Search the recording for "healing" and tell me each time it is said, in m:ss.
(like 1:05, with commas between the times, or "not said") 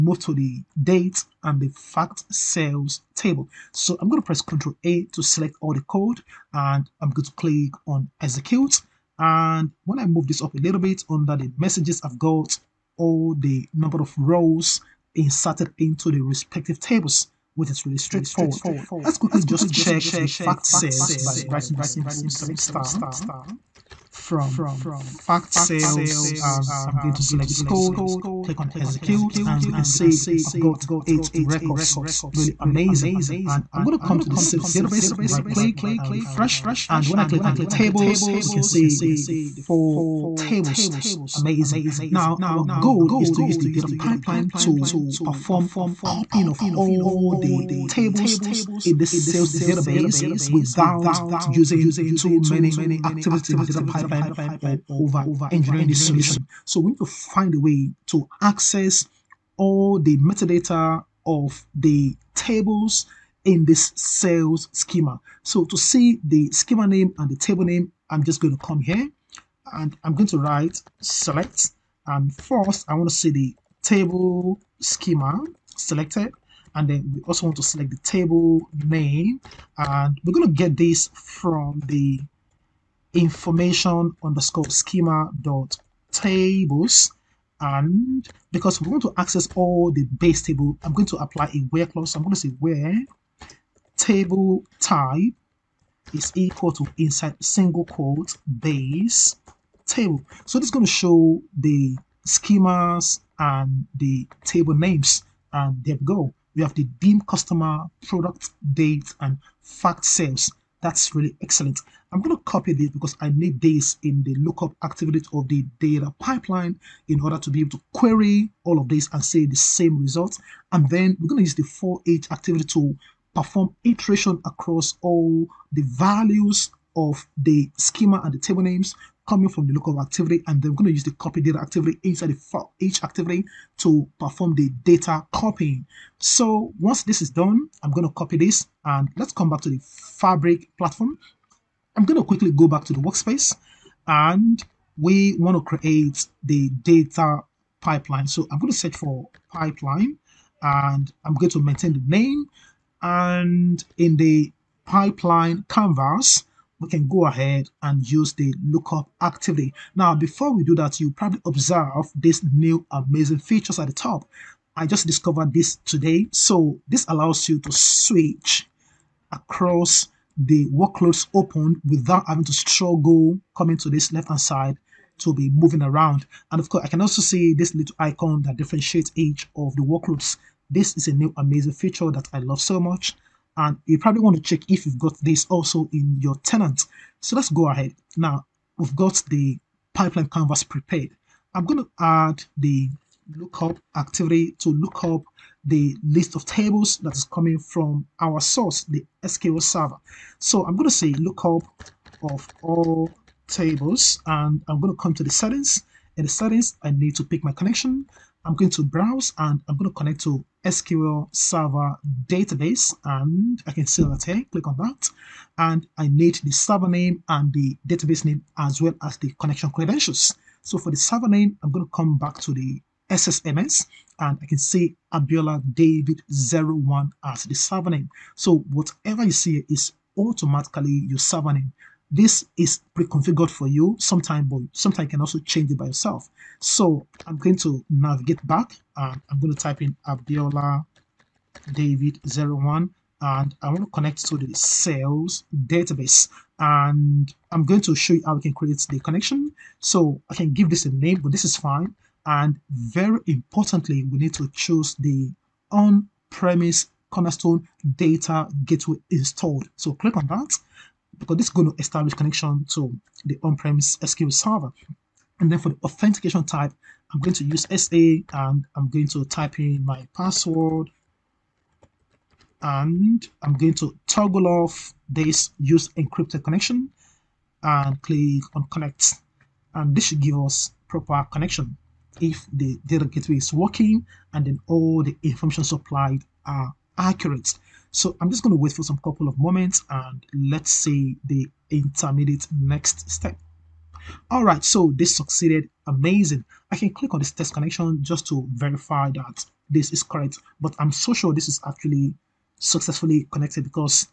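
not said.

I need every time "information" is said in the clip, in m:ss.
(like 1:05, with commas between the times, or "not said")
1:23, 4:45.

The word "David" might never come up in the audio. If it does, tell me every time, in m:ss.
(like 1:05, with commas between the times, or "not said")
3:45, 4:01.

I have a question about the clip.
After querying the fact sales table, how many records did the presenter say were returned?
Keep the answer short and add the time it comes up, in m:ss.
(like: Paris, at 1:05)
8, at 0:31.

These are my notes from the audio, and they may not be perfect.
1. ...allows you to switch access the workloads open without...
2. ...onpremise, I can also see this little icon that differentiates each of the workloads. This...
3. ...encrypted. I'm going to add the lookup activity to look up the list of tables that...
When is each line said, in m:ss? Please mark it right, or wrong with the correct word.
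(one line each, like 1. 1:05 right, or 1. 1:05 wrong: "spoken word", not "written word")
1. 2:47 wrong: "across", not "access"
2. 2:56 wrong: "course", not "onpremise"
3. 3:10 wrong: "prepared", not "encrypted".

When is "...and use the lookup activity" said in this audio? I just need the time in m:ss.
2:37.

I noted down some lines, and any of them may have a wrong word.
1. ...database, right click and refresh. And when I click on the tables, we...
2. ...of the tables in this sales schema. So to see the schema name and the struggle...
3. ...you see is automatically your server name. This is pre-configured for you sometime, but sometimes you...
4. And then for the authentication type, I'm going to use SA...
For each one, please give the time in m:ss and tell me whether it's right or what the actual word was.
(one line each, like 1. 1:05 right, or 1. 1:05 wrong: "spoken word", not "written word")
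1. 0:34 right
2. 1:01 wrong: "table", not "struggle"
3. 3:49 right
4. 4:25 right.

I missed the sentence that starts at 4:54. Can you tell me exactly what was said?
All right, so this succeeded, amazing.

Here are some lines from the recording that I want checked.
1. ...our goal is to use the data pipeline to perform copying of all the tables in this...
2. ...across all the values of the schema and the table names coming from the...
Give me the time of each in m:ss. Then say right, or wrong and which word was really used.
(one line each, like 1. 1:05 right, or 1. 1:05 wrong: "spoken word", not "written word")
1. 0:42 right
2. 2:04 right.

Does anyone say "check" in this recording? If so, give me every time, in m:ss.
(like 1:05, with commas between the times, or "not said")
0:19, 3:04.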